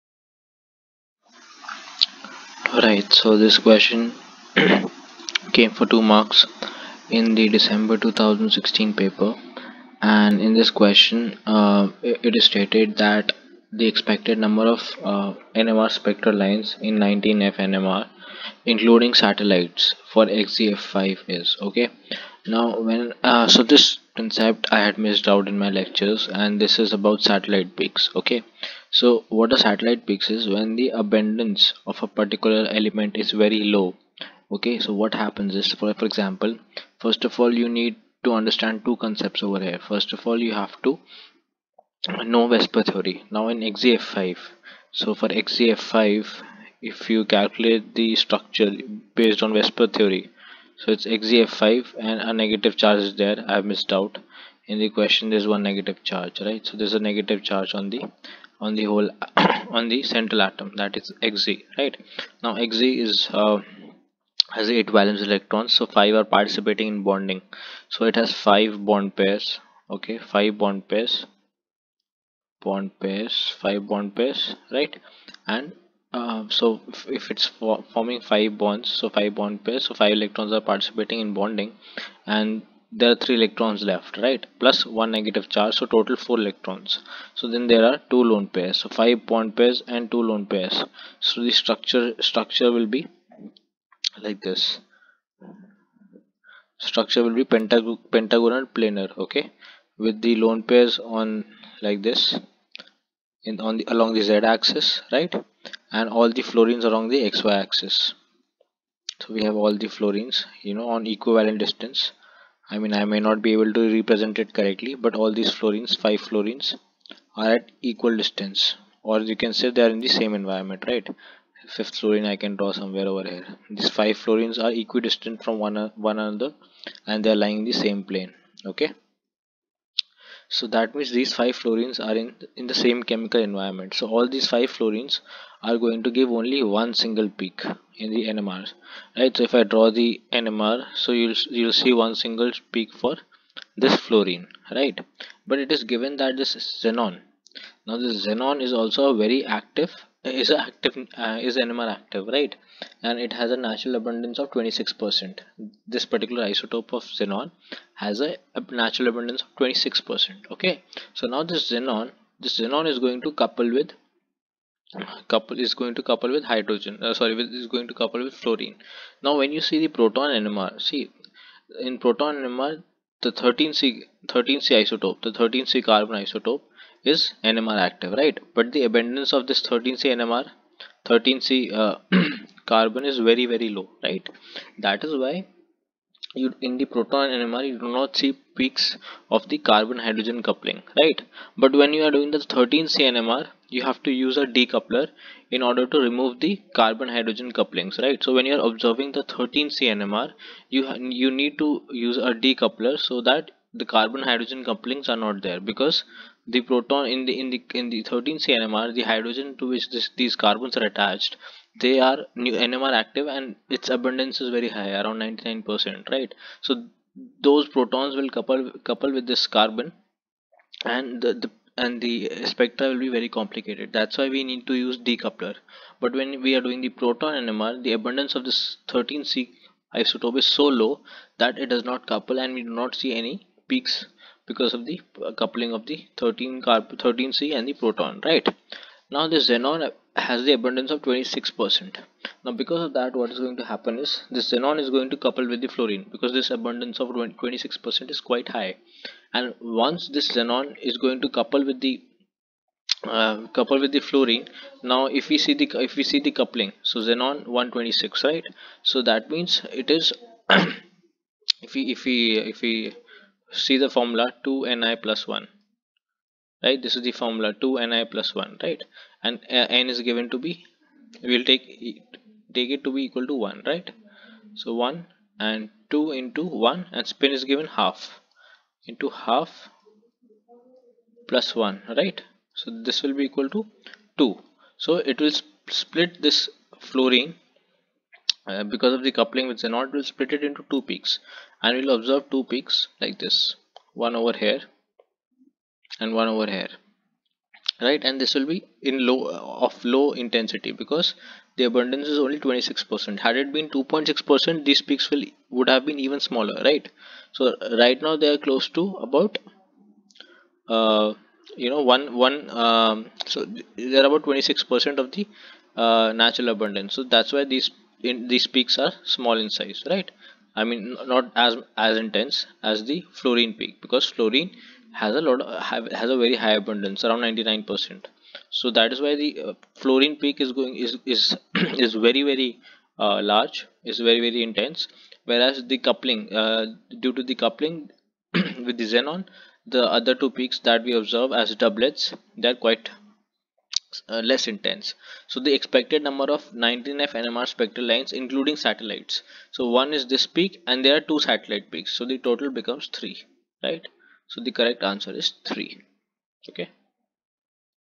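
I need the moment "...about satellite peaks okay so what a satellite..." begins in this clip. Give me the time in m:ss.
0:26.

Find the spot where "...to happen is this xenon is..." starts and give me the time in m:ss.
4:03.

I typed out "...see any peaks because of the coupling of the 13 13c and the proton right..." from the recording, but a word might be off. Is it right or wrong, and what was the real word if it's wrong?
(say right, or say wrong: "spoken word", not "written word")
right.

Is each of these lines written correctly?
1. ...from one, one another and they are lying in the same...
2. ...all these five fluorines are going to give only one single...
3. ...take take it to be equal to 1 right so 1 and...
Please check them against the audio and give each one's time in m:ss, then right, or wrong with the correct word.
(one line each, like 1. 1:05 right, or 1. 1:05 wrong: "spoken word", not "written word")
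1. 2:05 right
2. 2:14 right
3. 4:31 right.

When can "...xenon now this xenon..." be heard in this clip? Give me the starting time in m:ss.
2:26.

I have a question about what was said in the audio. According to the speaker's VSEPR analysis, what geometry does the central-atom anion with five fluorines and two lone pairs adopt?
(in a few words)
pentagonal planar.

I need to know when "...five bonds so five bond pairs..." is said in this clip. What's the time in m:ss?
1:18.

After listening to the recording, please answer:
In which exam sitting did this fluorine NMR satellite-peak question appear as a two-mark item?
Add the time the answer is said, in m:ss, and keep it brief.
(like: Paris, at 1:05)
December 2016, at 0:07.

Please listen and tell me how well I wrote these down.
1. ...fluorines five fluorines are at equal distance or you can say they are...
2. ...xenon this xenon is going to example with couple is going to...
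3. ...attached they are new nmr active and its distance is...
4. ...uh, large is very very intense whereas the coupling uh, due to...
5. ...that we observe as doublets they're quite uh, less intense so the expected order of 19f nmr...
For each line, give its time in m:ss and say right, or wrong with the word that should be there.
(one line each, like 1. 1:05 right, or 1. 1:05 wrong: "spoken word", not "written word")
1. 1:55 right
2. 2:41 wrong: "couple", not "example"
3. 3:30 wrong: "abundance", not "distance"
4. 5:32 right
5. 5:40 wrong: "number", not "order".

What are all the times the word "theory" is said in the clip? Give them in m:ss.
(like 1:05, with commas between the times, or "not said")
0:42, 0:49.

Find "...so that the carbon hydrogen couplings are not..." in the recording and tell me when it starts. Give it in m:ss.
3:22.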